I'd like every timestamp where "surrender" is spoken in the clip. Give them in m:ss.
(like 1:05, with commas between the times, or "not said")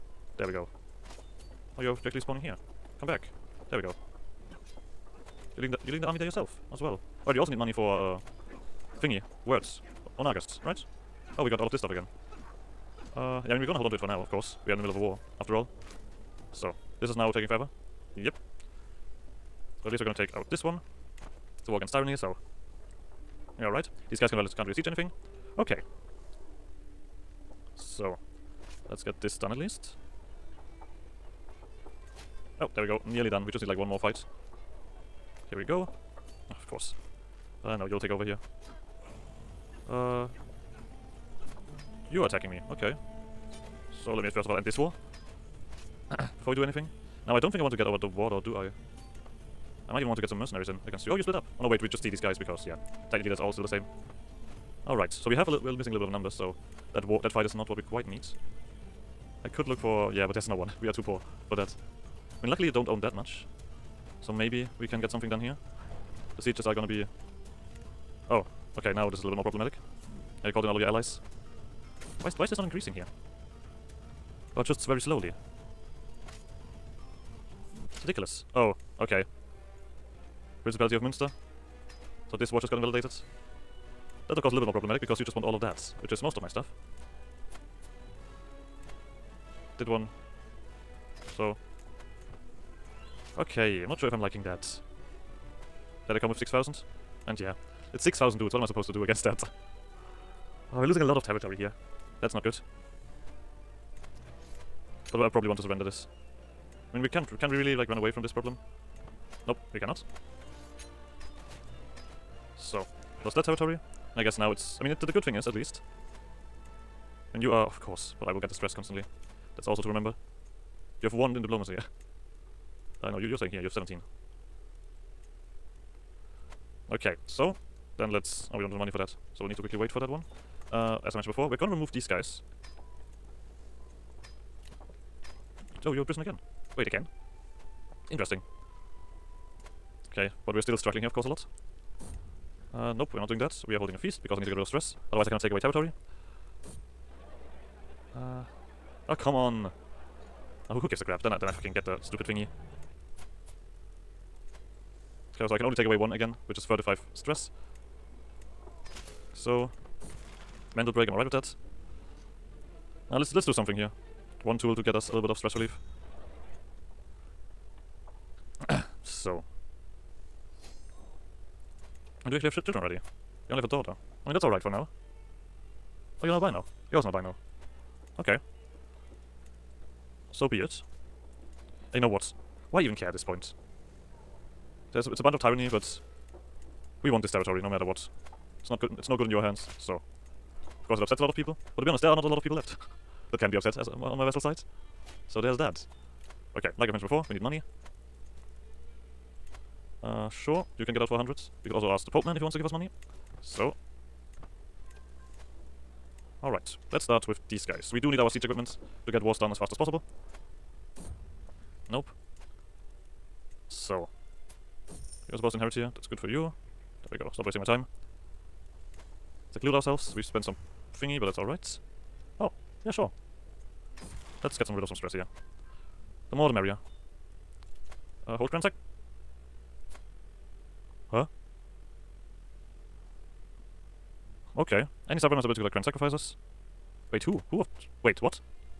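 1:45.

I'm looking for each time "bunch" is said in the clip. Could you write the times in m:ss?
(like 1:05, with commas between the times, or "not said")
3:05.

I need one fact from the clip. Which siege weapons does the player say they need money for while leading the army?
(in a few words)
Onagers.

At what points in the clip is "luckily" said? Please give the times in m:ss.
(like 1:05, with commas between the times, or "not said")
1:02.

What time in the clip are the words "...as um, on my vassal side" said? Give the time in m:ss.
3:13.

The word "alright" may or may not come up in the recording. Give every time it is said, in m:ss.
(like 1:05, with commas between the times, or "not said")
0:07, 0:54, 2:54, 3:26, 3:41.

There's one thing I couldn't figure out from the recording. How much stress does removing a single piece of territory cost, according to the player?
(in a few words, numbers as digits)
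35.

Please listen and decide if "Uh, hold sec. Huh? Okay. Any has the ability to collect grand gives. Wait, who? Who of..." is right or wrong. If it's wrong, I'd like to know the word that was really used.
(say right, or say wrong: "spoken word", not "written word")
wrong: "sacrifices", not "gives".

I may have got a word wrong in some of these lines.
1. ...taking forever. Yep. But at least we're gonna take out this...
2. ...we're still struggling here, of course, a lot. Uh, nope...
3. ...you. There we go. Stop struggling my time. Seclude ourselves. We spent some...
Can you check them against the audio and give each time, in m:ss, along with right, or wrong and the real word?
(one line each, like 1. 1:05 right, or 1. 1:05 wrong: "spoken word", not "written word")
1. 0:17 right
2. 2:20 right
3. 3:36 wrong: "wasting", not "struggling".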